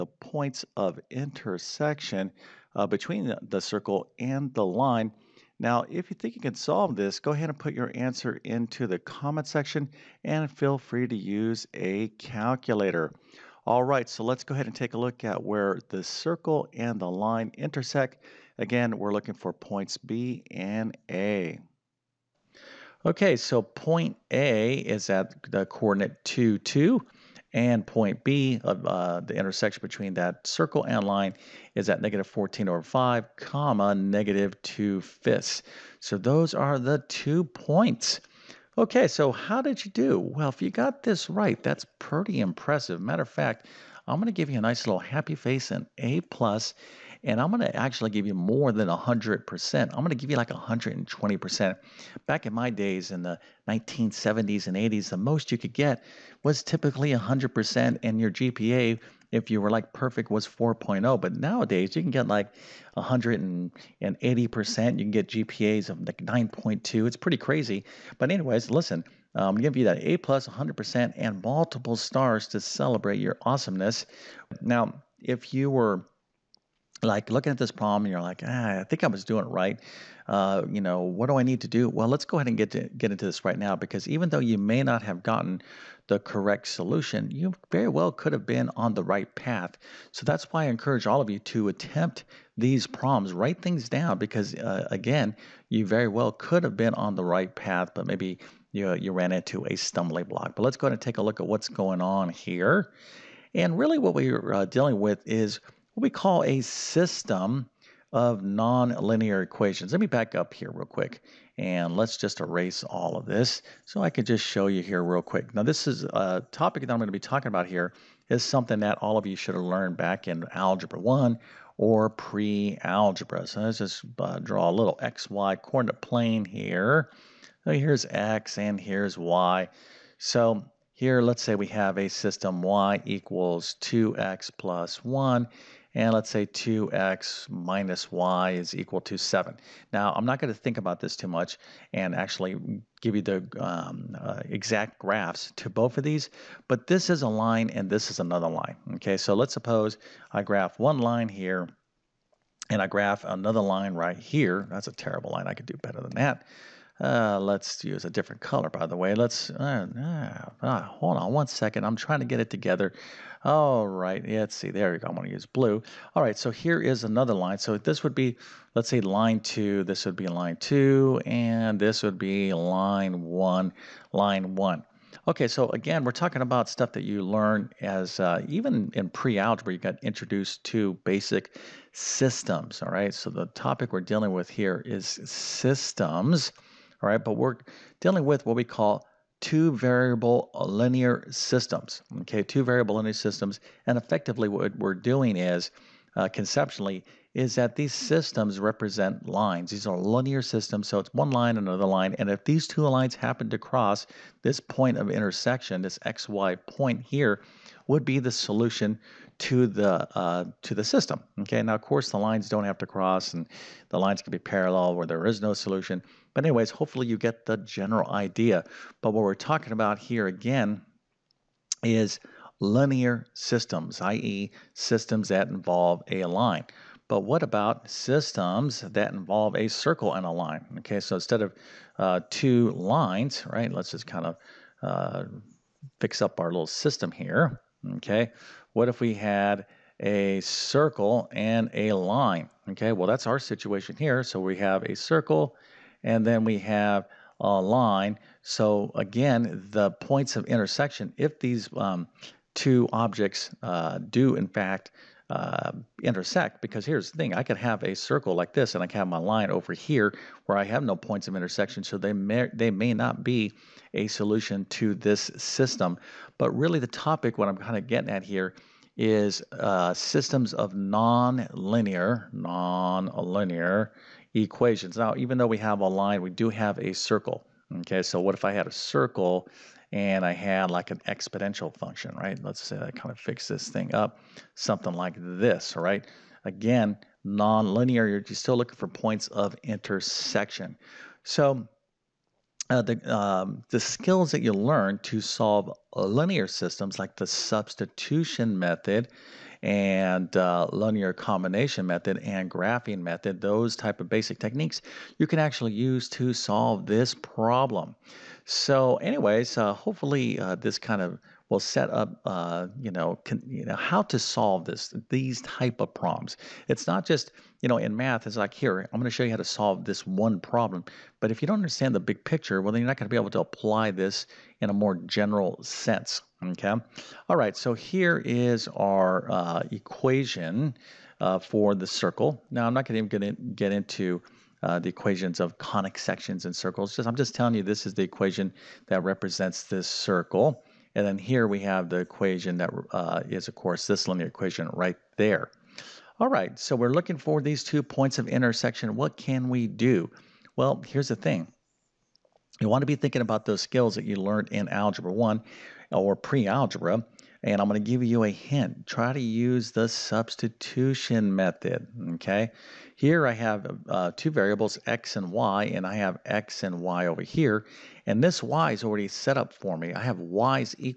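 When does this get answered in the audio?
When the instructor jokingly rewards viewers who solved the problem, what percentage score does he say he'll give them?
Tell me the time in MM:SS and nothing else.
00:50.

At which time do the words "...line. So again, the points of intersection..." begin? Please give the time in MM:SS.
04:07.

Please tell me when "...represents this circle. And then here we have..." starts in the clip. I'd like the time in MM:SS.
05:39.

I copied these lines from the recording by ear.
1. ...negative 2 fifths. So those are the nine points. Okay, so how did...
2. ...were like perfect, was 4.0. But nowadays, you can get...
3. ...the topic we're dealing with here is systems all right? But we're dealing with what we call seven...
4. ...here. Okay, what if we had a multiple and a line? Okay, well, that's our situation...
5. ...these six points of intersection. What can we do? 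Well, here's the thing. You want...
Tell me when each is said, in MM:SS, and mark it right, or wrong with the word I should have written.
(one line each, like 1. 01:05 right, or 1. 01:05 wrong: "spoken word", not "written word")
1. 00:33 wrong: "two", not "nine"
2. 00:59 right
3. 03:03 wrong: "two", not "seven"
4. 03:57 wrong: "circle", not "multiple"
5. 05:47 wrong: "two", not "six".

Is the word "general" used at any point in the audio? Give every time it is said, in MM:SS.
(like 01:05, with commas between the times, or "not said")
03:37, 05:25.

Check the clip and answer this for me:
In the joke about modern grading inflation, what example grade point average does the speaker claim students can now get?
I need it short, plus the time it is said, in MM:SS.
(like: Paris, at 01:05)
9.2, at 01:06.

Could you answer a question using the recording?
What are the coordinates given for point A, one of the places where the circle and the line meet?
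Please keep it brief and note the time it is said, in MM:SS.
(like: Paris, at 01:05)
(2, 2), at 00:26.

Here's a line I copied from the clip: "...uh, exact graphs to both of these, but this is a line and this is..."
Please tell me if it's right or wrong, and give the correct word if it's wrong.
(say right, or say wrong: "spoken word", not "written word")
right.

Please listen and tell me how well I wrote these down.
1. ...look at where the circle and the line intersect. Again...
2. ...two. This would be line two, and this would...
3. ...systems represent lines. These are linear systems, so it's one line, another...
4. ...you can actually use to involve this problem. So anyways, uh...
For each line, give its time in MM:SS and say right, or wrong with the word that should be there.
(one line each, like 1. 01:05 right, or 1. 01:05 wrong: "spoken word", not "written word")
1. 00:14 right
2. 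02:49 right
3. 03:17 right
4. 05:05 wrong: "solve", not "involve".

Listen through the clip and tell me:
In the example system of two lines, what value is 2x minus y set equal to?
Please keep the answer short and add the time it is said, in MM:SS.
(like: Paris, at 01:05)
7, at 02:19.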